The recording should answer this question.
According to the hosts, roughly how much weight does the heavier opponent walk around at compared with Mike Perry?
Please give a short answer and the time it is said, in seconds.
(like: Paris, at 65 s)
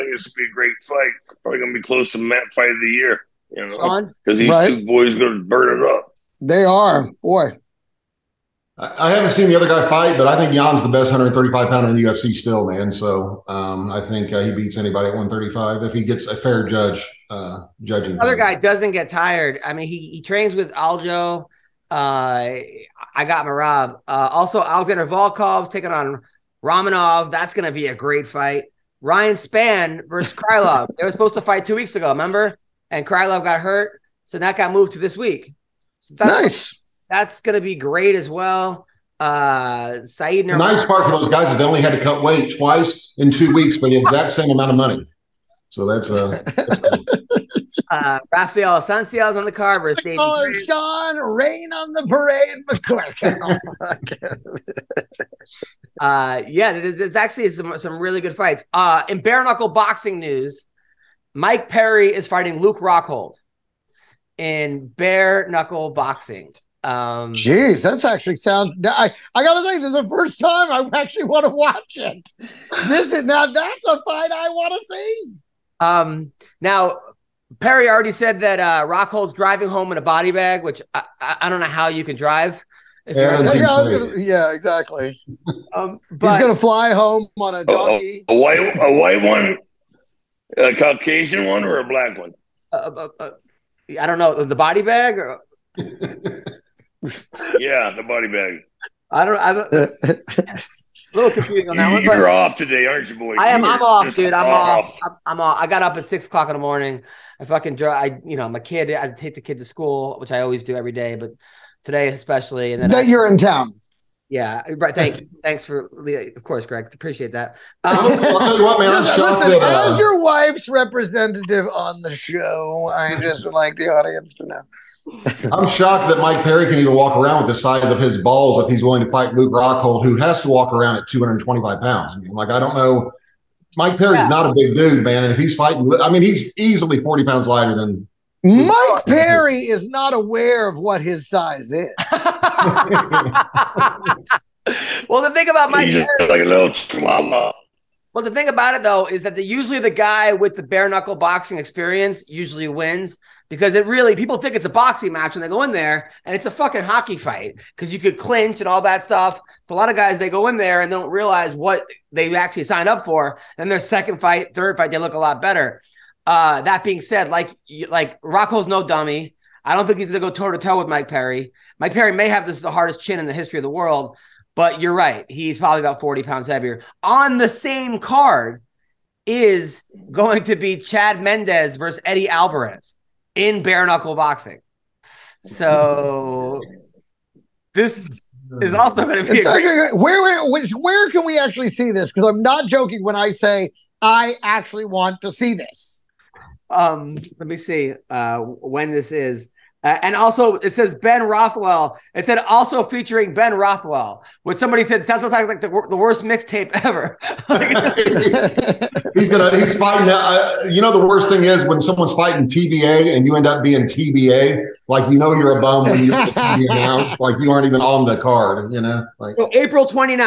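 225 pounds, at 131 s.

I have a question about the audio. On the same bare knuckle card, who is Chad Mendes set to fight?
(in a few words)
Eddie Alvarez.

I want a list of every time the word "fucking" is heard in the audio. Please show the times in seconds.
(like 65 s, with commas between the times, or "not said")
107 s, 156 s.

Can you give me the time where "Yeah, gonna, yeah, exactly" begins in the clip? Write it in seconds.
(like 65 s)
83 s.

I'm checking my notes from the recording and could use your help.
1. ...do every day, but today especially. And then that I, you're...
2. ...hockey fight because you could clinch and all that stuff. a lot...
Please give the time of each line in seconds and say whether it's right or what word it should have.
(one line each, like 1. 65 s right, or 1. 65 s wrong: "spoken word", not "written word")
1. 110 s right
2. 156 s right.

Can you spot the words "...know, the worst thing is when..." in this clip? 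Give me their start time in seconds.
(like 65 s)
210 s.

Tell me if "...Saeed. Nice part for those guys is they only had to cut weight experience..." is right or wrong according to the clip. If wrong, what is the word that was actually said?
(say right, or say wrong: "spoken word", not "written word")
wrong: "twice", not "experience".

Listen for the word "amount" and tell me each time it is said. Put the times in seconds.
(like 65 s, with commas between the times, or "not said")
44 s.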